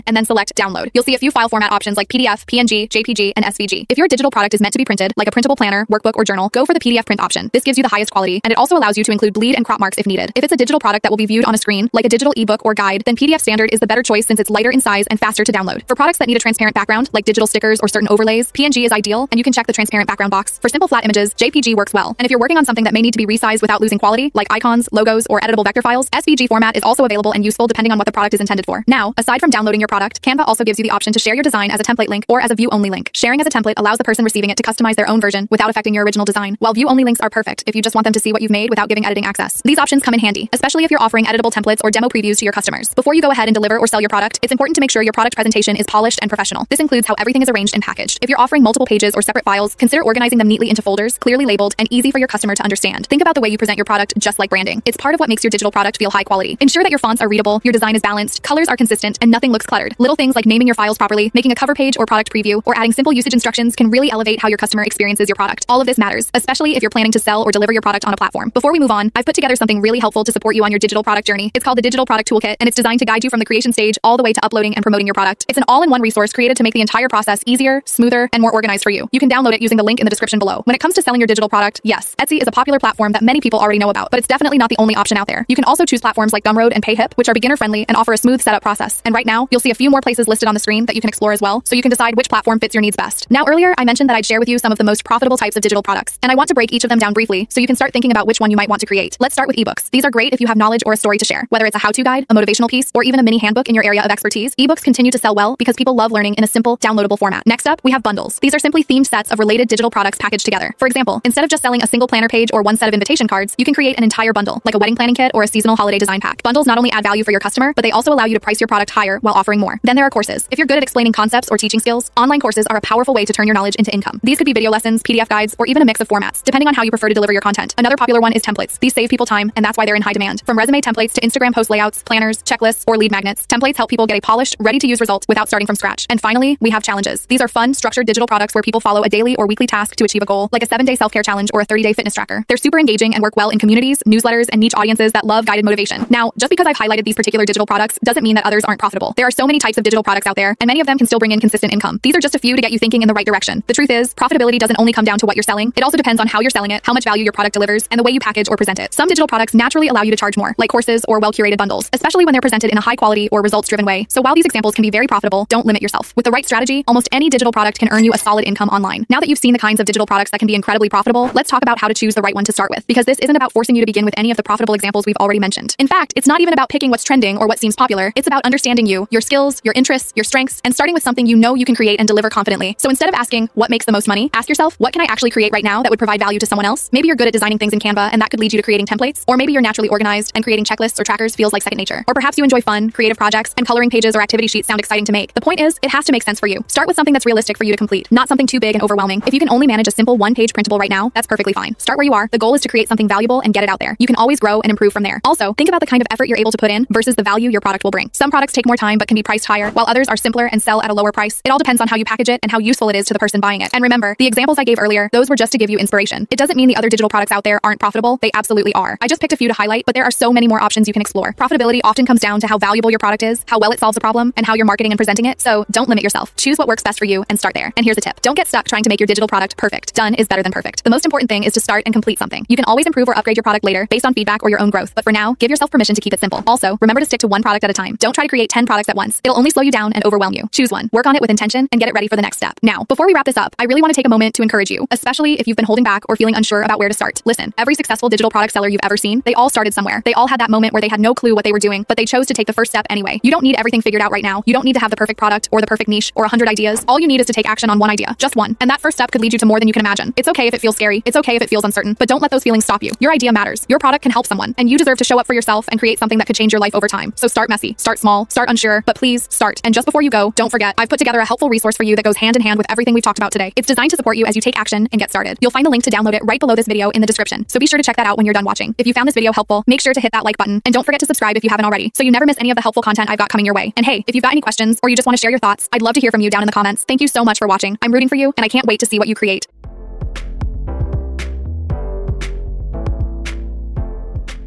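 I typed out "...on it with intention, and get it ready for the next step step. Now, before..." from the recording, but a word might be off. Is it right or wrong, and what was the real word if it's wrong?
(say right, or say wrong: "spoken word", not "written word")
right.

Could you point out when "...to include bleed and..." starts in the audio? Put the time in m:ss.
0:09.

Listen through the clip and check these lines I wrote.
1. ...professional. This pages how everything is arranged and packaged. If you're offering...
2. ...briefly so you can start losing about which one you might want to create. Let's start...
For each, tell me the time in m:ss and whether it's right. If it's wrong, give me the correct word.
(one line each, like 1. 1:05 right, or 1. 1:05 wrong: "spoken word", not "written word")
1. 0:46 wrong: "includes", not "pages"
2. 1:37 wrong: "thinking", not "losing".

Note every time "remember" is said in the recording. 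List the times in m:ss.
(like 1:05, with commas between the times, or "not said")
3:33, 3:56.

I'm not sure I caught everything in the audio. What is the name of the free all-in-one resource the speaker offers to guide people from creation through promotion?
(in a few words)
Digital Product Toolkit.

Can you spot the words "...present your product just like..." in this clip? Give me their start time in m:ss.
0:53.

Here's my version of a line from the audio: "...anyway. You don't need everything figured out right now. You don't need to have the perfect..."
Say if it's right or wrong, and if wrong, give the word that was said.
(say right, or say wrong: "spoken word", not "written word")
right.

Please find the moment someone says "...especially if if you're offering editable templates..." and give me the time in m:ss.
0:40.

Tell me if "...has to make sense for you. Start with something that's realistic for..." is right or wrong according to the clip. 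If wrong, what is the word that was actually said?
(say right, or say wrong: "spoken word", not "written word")
right.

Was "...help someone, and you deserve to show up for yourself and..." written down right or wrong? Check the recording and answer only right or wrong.
right.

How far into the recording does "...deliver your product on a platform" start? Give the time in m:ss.
1:07.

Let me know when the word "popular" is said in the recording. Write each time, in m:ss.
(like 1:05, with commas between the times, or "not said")
1:22, 2:07, 2:57.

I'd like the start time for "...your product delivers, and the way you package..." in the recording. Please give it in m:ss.
2:37.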